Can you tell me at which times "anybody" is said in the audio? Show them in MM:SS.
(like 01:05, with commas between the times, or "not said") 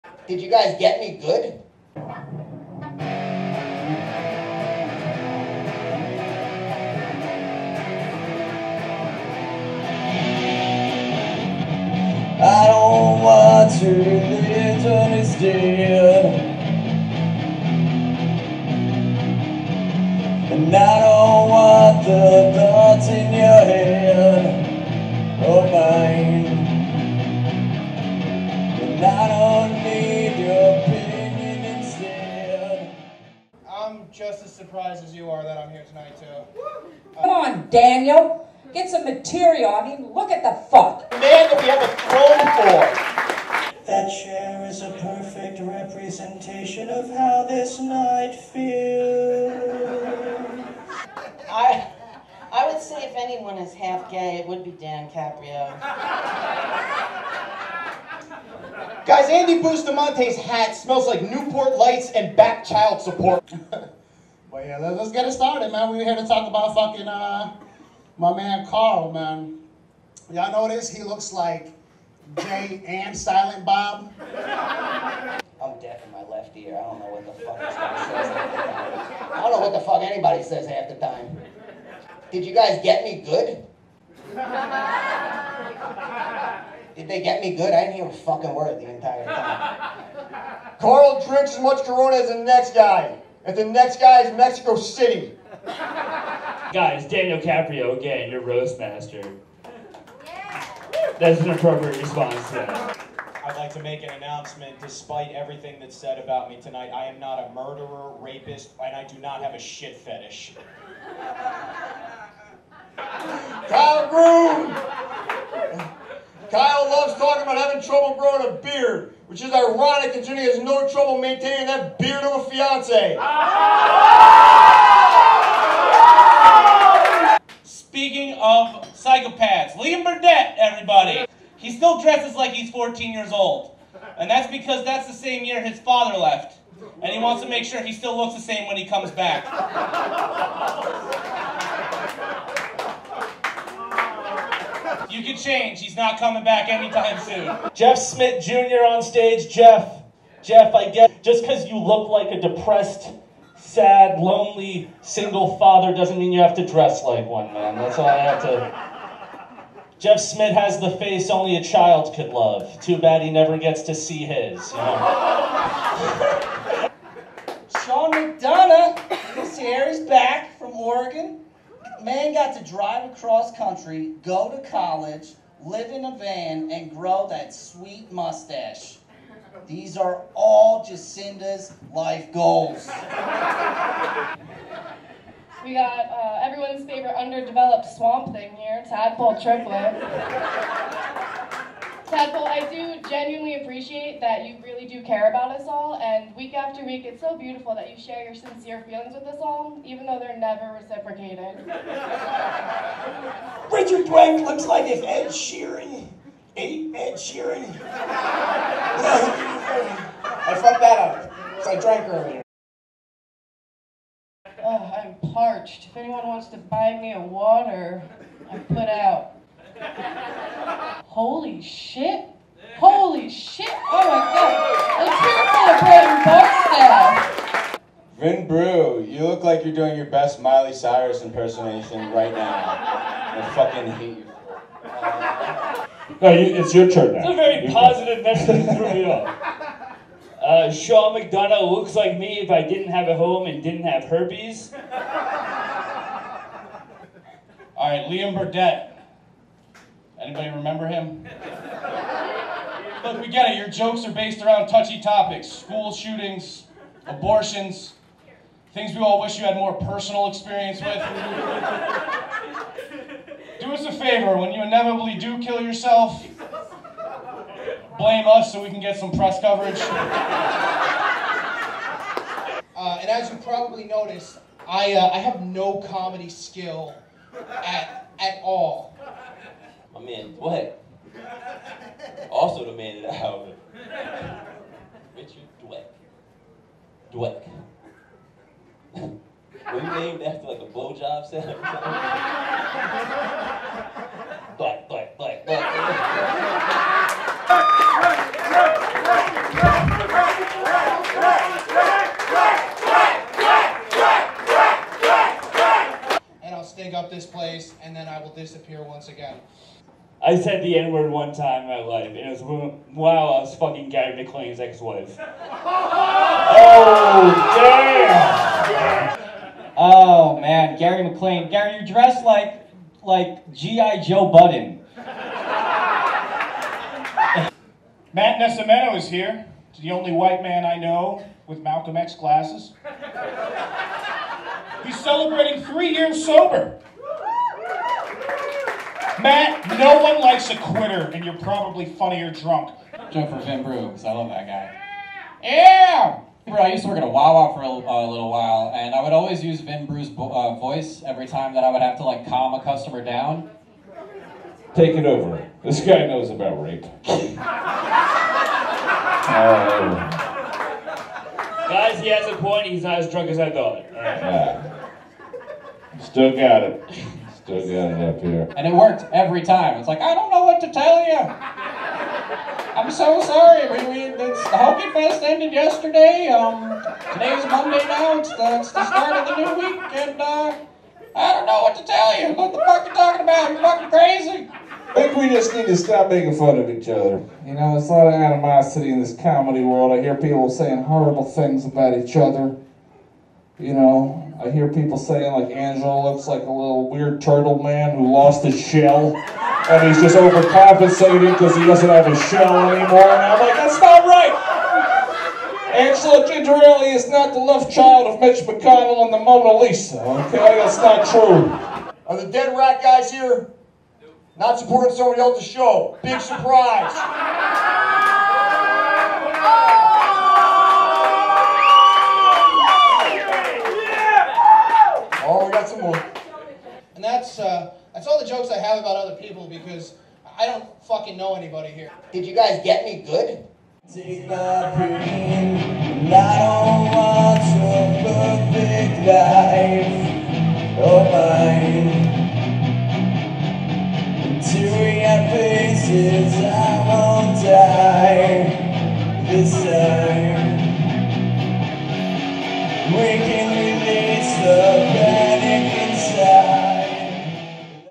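01:20, 04:10, 07:11.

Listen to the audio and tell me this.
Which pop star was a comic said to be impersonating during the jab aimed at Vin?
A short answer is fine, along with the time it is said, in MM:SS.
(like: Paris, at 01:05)
Miley Cyrus, at 03:50.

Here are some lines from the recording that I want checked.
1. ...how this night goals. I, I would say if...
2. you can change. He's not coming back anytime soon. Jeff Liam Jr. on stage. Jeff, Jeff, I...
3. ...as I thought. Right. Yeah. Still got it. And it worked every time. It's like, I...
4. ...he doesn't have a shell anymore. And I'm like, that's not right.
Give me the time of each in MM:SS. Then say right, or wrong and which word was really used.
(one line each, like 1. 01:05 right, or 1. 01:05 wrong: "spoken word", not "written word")
1. 00:47 wrong: "feels", not "goals"
2. 02:25 wrong: "Smith", not "Liam"
3. 06:03 right
4. 06:41 right.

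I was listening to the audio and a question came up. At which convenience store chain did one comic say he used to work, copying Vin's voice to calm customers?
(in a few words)
Wawa.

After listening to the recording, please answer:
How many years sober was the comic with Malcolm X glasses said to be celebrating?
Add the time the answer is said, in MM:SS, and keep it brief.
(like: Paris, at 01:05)
3, at 05:35.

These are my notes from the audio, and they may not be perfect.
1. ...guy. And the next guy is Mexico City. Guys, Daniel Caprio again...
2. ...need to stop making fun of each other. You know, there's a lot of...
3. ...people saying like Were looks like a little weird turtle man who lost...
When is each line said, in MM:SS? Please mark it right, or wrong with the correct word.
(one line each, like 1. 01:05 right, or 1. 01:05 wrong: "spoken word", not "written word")
1. 01:32 right
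2. 06:25 right
3. 06:34 wrong: "Angelo", not "Were".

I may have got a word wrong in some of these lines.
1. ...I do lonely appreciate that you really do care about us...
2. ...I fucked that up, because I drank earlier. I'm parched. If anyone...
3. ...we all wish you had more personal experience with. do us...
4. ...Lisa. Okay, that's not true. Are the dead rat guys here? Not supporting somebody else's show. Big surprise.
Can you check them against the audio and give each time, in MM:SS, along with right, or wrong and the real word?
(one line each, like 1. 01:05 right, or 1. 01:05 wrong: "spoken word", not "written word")
1. 03:12 wrong: "genuinely", not "lonely"
2. 03:30 right
3. 04:18 right
4. 06:49 right.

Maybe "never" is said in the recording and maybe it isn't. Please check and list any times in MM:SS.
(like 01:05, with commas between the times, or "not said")
02:43, 03:20.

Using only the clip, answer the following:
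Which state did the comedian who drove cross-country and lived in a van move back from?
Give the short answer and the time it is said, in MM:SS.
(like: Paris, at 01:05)
Oregon, at 02:50.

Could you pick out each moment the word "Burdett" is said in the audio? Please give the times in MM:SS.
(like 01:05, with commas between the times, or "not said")
02:10, 04:08.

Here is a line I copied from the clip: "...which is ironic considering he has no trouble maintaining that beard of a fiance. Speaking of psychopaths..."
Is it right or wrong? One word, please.
right.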